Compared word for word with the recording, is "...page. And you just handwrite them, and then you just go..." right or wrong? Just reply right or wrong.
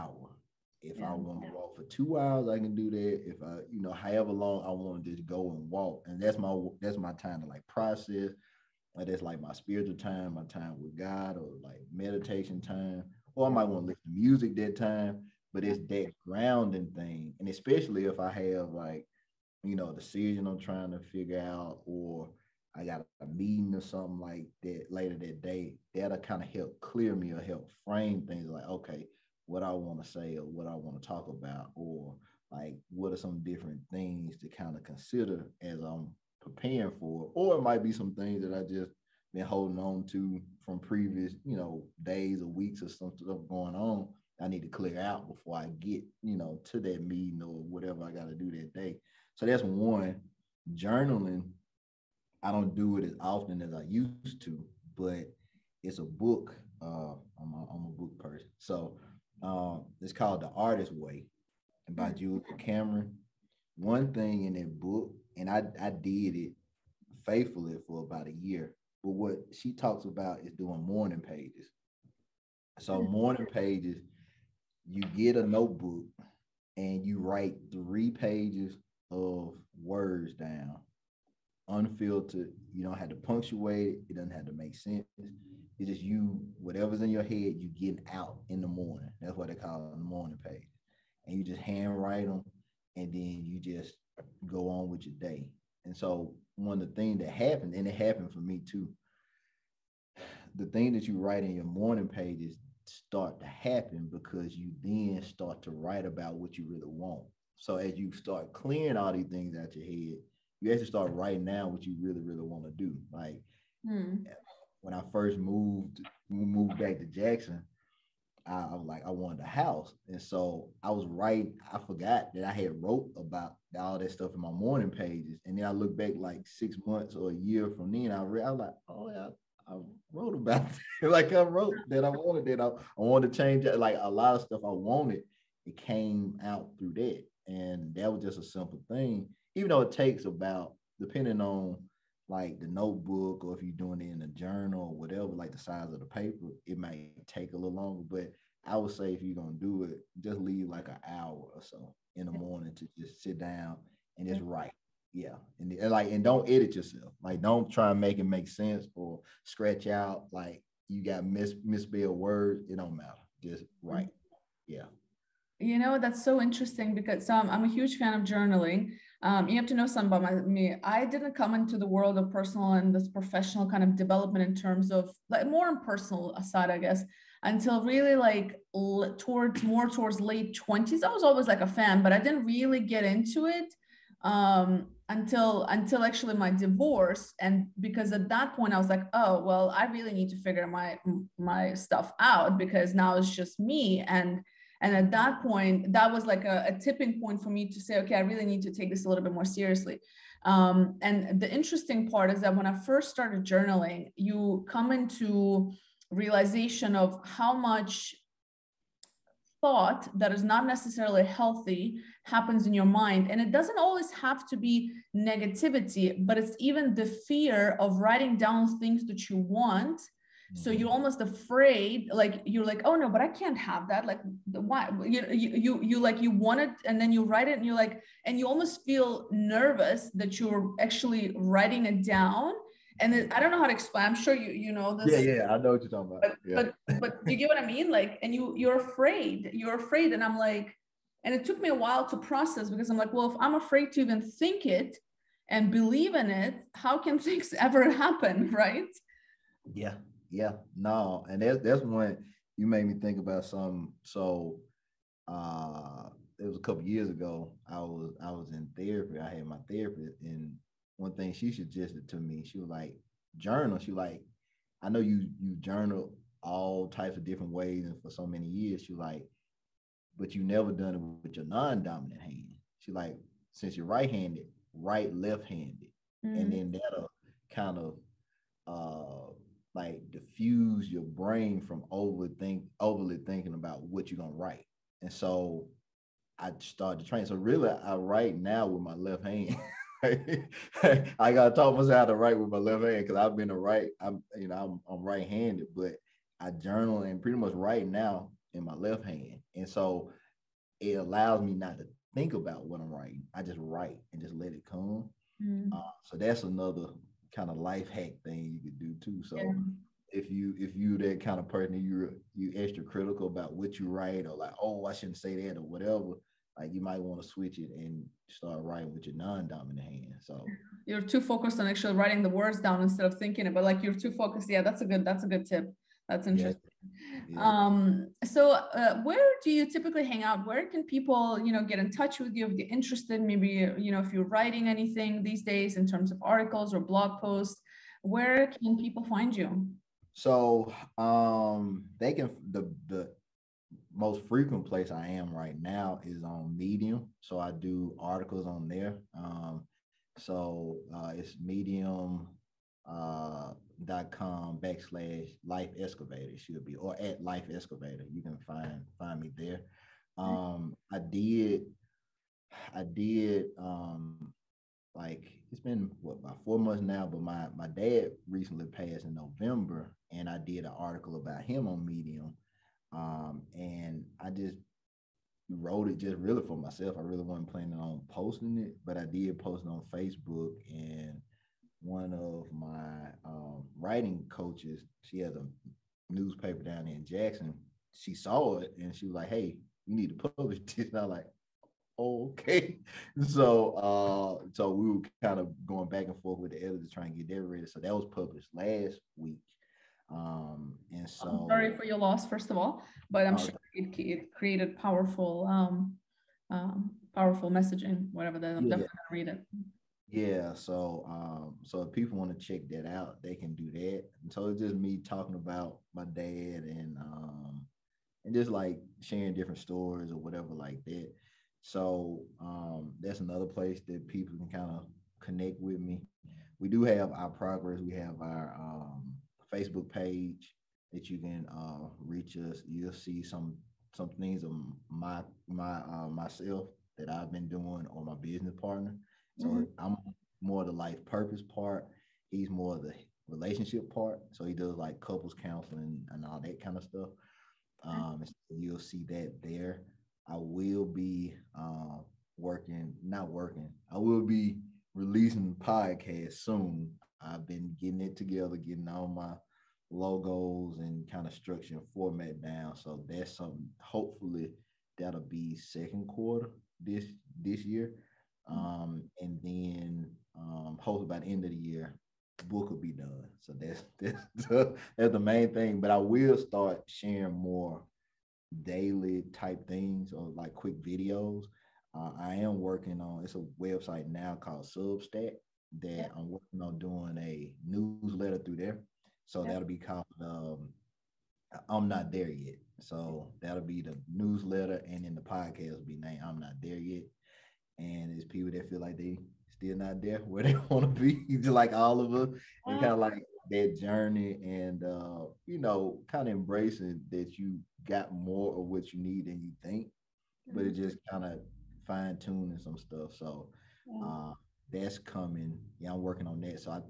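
right.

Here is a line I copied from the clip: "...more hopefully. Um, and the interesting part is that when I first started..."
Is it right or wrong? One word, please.
wrong.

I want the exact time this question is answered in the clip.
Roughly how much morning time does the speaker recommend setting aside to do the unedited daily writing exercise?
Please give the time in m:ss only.
2:30.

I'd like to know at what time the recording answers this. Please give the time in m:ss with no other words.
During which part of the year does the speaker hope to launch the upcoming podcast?
7:45.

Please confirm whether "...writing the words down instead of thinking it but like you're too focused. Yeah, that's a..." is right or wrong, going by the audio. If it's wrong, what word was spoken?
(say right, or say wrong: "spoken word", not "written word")
right.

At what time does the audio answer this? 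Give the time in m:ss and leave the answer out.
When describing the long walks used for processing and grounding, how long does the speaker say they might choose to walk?
0:01.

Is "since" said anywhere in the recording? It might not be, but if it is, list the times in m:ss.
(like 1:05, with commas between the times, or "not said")
4:33.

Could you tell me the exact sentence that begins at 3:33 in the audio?
And it doesn't always have to be negativity, but it's even the fear of writing down things that you want so mm-hmm.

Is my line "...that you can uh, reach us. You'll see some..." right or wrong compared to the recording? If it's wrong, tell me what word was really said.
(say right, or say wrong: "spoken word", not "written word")
right.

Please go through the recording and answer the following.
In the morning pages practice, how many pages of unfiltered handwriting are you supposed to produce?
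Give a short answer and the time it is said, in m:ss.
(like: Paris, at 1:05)
3 pages, at 1:17.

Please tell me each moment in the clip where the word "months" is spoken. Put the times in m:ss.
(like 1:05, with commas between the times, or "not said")
2:06, 6:06.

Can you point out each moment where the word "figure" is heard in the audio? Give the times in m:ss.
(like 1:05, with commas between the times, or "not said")
0:21, 3:10.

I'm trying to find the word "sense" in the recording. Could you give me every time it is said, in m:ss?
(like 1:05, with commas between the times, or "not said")
1:24, 2:38.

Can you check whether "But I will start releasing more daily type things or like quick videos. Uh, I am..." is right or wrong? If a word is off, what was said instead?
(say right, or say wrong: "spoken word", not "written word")
wrong: "sharing", not "releasing".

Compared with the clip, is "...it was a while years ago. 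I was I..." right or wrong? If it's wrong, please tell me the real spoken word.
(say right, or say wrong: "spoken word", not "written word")
wrong: "couple", not "while".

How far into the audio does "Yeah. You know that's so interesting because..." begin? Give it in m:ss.
2:44.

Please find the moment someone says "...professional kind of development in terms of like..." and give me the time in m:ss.
2:53.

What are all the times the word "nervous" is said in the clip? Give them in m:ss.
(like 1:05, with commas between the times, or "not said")
3:49.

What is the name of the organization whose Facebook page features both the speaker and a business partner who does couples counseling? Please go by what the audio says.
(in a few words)
iProgress.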